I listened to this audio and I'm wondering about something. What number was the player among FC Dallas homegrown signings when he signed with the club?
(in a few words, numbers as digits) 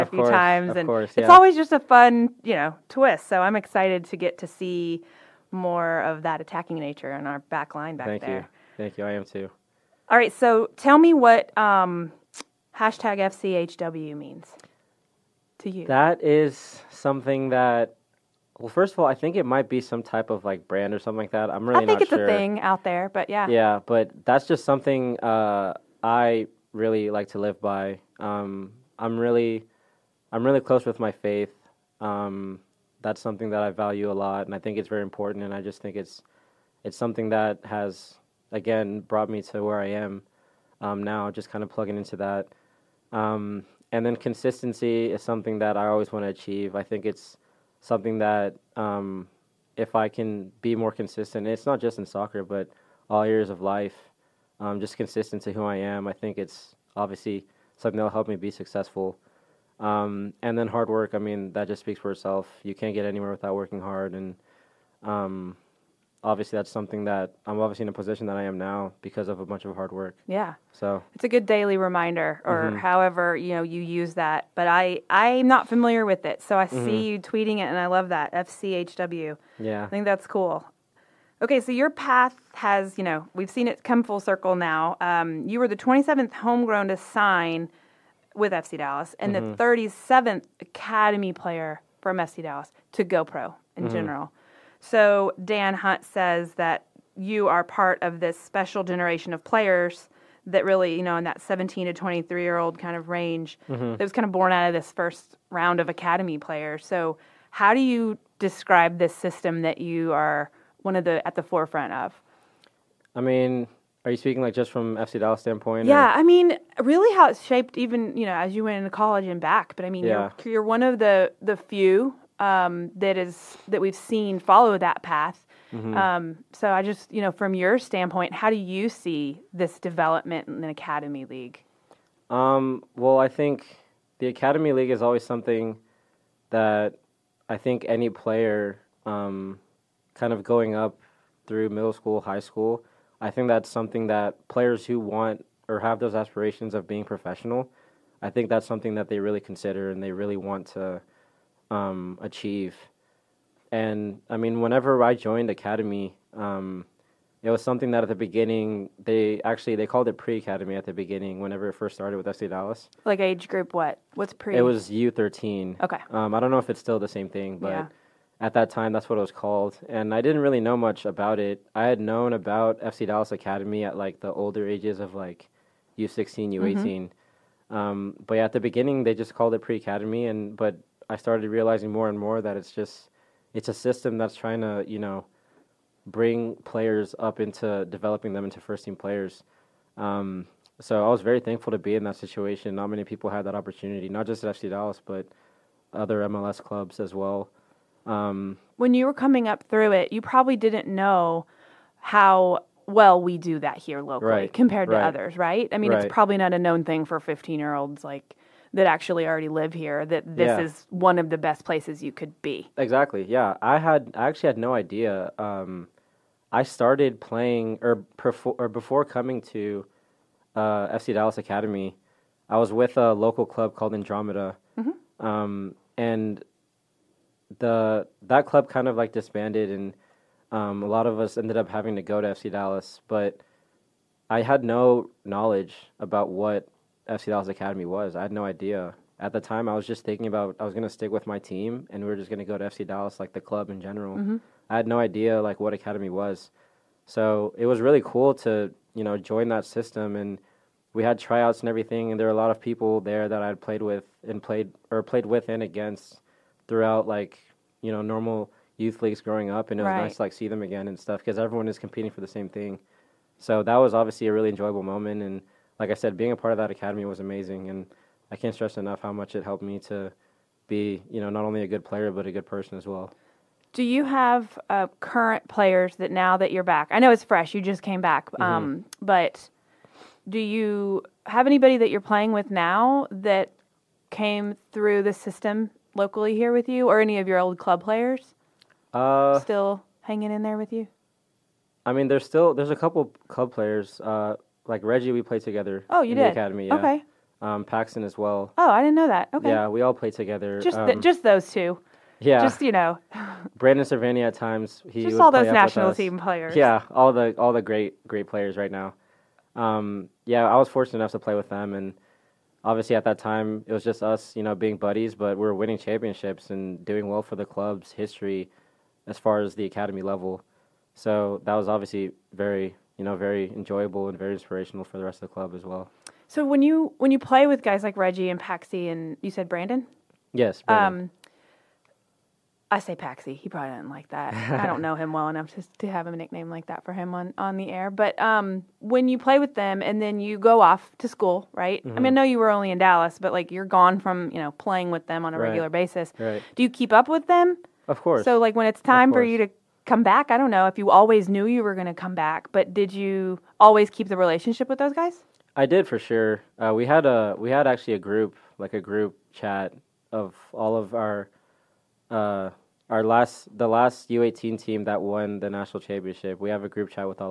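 27th.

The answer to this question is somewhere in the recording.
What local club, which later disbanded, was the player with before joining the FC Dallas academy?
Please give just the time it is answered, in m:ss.
3:43.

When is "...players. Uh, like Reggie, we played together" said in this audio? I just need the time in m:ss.
4:53.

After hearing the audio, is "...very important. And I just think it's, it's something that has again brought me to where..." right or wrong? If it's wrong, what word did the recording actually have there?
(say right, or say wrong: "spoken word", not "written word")
right.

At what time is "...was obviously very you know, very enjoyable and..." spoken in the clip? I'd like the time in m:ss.
5:21.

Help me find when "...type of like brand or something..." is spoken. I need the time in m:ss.
0:20.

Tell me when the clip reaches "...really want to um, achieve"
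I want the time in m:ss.
2:30.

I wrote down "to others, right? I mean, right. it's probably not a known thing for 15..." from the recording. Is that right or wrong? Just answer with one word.
right.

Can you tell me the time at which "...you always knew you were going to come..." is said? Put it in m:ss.
5:50.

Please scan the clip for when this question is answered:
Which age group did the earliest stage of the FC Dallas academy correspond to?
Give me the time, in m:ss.
2:44.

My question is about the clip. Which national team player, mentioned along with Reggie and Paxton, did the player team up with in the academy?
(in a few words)
Brandon Servania.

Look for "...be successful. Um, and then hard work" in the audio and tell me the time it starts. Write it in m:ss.
0:58.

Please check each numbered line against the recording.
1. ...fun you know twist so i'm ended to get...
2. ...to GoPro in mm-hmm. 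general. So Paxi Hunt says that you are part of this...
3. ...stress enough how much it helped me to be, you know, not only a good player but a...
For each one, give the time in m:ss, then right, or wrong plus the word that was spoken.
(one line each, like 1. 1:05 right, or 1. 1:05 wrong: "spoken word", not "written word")
1. 0:01 wrong: "excited", not "ended"
2. 1:32 wrong: "Dan", not "Paxi"
3. 4:28 right.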